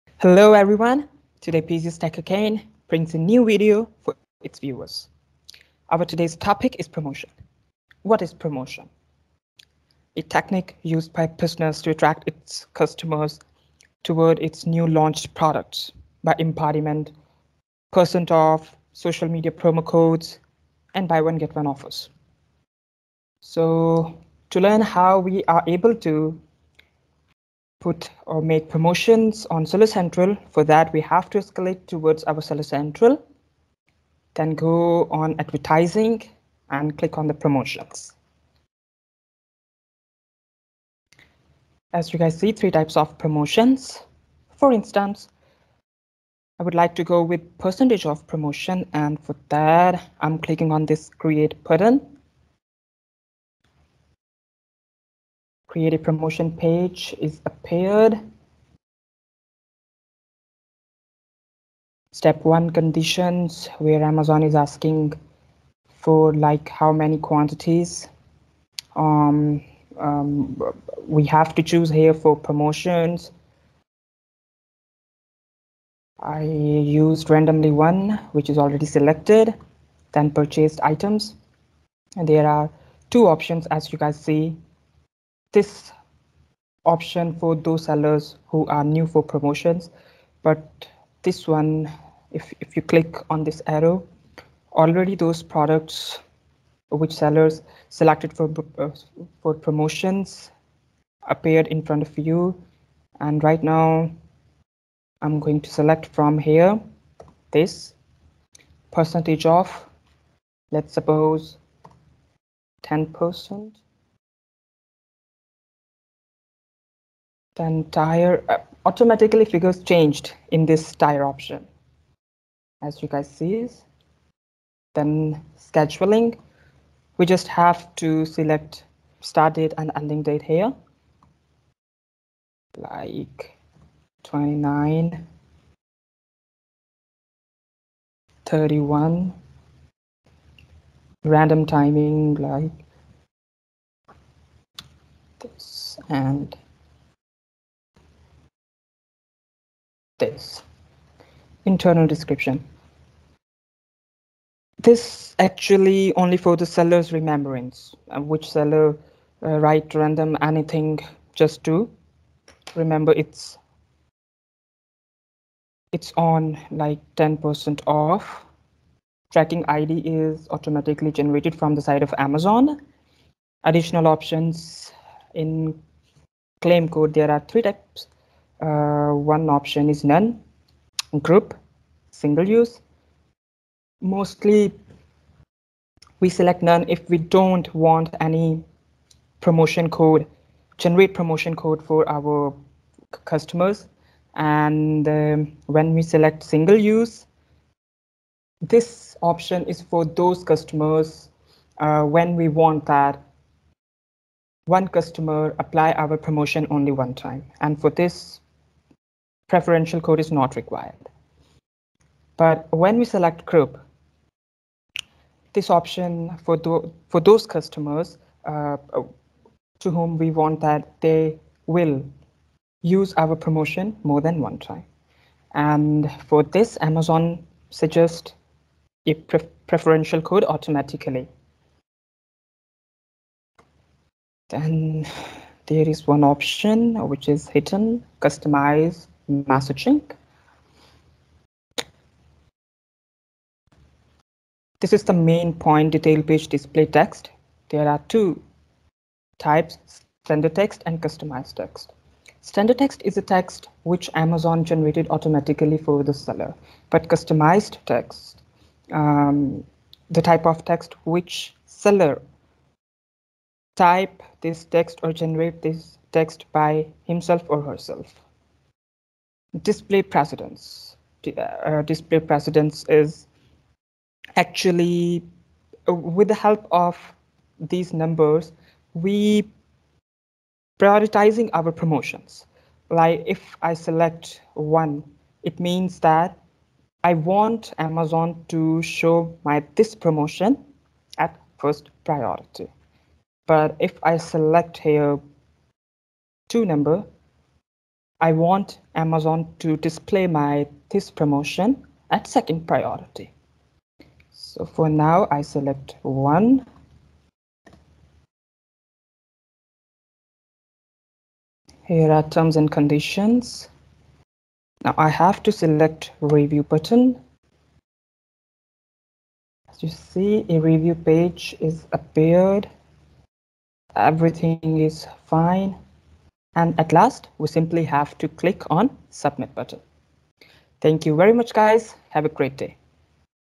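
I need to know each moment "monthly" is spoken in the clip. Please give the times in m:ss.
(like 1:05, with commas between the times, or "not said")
not said.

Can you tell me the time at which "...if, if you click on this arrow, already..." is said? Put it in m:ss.
1:32.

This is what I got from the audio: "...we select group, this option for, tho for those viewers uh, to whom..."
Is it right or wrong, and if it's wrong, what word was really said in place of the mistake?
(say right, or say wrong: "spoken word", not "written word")
wrong: "customers", not "viewers".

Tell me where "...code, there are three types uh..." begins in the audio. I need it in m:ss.
2:56.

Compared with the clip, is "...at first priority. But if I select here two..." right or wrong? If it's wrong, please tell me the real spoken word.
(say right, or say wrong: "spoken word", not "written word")
right.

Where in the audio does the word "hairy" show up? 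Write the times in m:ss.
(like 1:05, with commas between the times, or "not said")
not said.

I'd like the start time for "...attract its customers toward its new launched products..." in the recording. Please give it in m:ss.
0:11.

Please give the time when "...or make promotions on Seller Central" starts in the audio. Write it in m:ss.
0:28.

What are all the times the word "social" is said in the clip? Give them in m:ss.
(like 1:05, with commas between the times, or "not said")
0:18.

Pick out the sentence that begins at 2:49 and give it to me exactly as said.
Tracking ID is automatically generated from the side of Amazon.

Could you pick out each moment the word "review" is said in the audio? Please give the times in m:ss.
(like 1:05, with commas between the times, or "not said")
5:16, 5:20.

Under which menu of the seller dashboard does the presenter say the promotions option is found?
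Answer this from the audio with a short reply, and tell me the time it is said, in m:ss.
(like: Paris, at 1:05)
Advertising, at 0:35.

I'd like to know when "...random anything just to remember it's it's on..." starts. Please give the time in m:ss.
2:39.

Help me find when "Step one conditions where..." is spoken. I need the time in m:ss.
1:02.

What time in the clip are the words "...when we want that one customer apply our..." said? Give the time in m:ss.
3:22.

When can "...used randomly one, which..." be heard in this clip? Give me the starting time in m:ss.
1:16.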